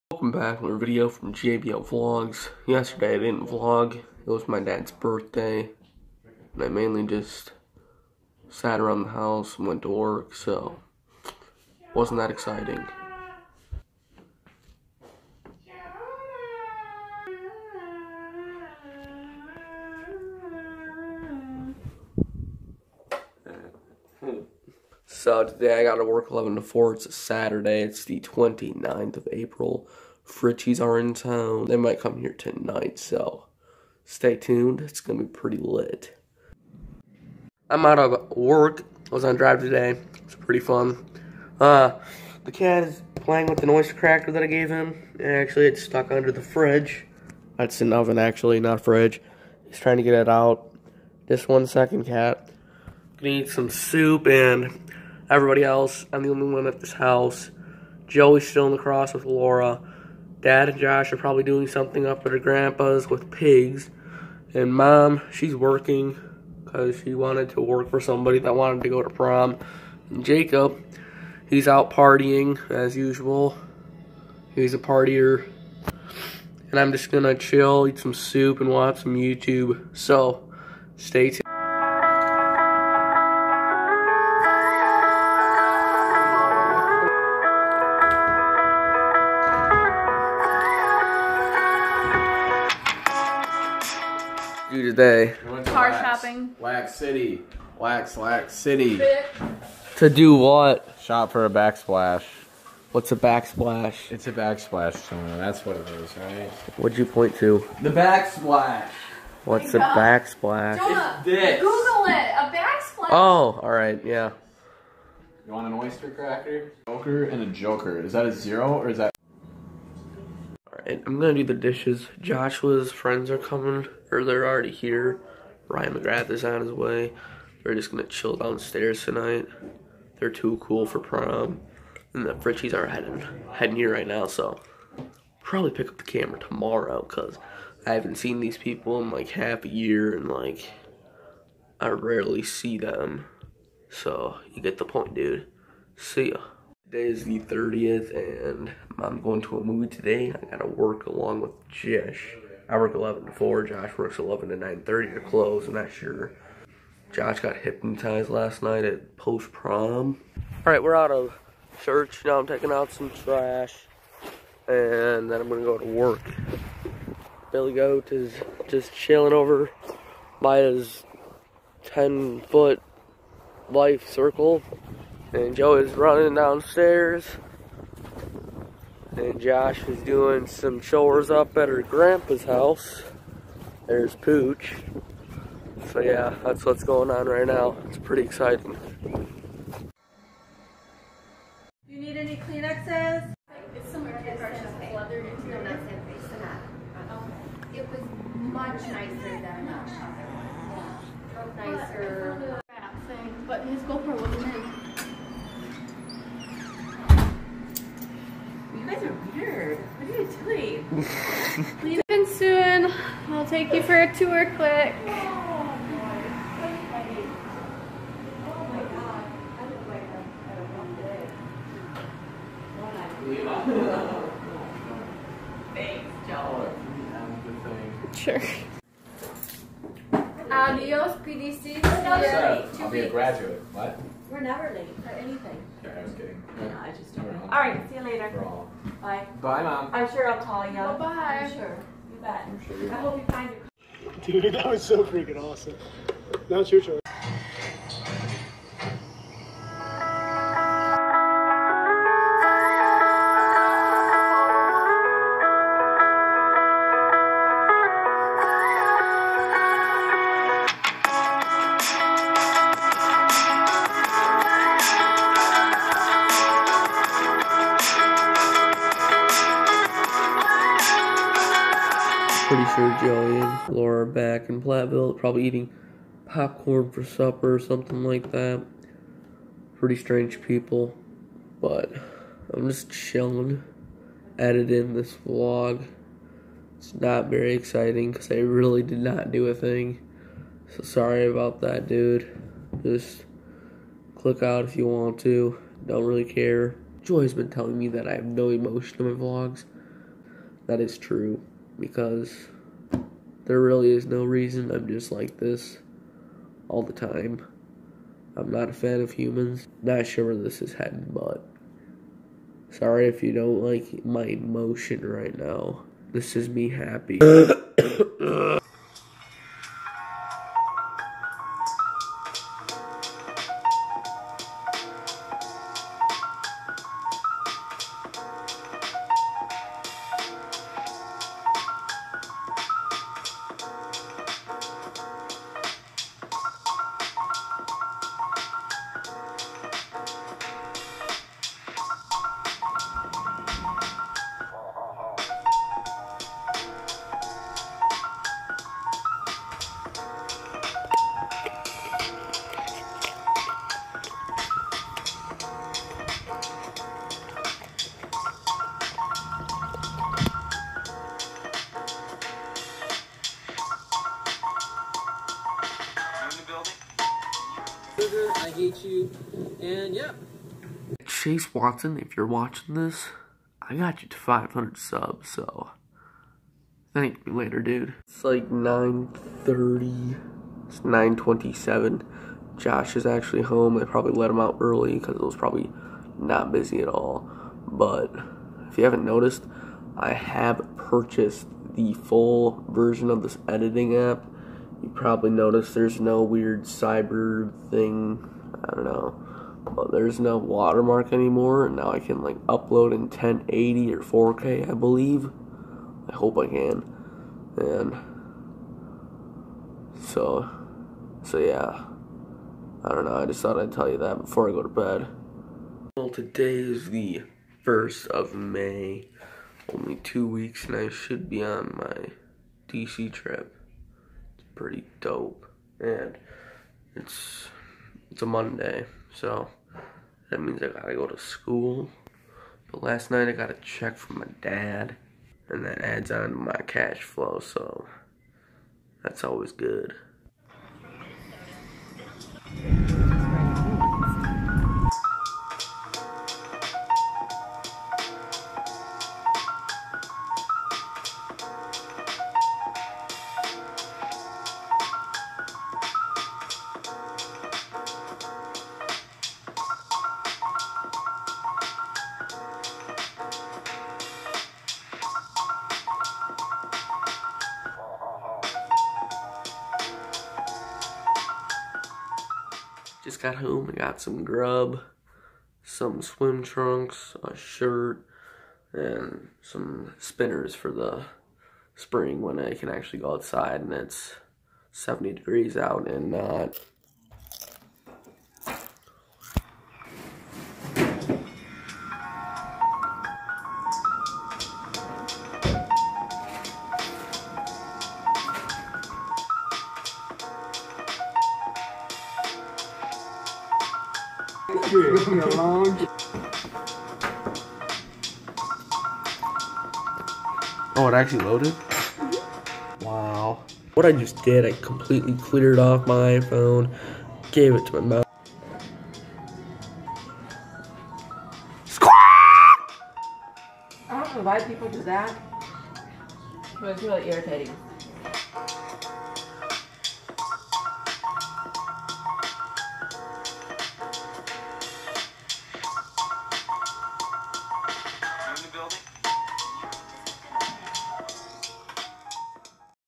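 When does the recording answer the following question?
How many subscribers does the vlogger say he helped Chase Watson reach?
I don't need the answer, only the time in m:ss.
6:14.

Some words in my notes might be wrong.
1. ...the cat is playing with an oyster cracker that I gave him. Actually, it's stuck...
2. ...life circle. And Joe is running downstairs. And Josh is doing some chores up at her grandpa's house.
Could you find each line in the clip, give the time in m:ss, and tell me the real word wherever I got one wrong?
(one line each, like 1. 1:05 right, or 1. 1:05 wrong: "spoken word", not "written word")
1. 0:42 right
2. 2:53 right.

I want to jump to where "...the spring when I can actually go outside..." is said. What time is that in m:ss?
8:00.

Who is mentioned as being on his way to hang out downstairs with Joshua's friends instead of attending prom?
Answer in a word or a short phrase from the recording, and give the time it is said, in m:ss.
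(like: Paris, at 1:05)
Ryan McGrath, at 2:05.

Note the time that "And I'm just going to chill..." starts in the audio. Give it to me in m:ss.
1:16.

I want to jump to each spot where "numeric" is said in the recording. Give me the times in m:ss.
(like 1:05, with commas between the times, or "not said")
not said.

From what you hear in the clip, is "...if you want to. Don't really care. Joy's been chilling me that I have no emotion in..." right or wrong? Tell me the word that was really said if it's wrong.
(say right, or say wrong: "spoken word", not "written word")
wrong: "telling", not "chilling".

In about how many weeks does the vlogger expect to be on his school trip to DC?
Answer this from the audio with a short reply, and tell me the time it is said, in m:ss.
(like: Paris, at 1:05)
2, at 6:59.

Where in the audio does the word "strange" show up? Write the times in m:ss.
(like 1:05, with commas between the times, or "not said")
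4:39.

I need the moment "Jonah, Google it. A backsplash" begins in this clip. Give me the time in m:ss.
1:50.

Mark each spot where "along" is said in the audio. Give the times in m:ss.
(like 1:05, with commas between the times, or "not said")
2:31.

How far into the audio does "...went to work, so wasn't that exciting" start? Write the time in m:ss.
0:09.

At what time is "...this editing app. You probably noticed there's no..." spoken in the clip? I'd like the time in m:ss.
6:33.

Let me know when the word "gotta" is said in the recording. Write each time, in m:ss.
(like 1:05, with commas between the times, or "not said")
2:30, 7:10.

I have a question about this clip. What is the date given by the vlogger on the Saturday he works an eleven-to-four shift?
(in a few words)
29th of April.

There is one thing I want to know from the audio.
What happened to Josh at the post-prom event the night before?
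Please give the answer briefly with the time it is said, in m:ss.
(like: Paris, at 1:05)
got hypnotized, at 2:37.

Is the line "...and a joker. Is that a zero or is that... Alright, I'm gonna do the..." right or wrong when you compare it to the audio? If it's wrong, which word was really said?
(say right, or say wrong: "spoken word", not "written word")
right.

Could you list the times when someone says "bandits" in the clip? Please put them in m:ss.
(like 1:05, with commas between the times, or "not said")
not said.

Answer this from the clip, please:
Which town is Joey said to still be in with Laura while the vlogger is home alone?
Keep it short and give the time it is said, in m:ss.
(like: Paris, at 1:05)
La Crosse, at 0:58.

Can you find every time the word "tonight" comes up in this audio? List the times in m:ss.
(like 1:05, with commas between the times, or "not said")
0:32, 2:09.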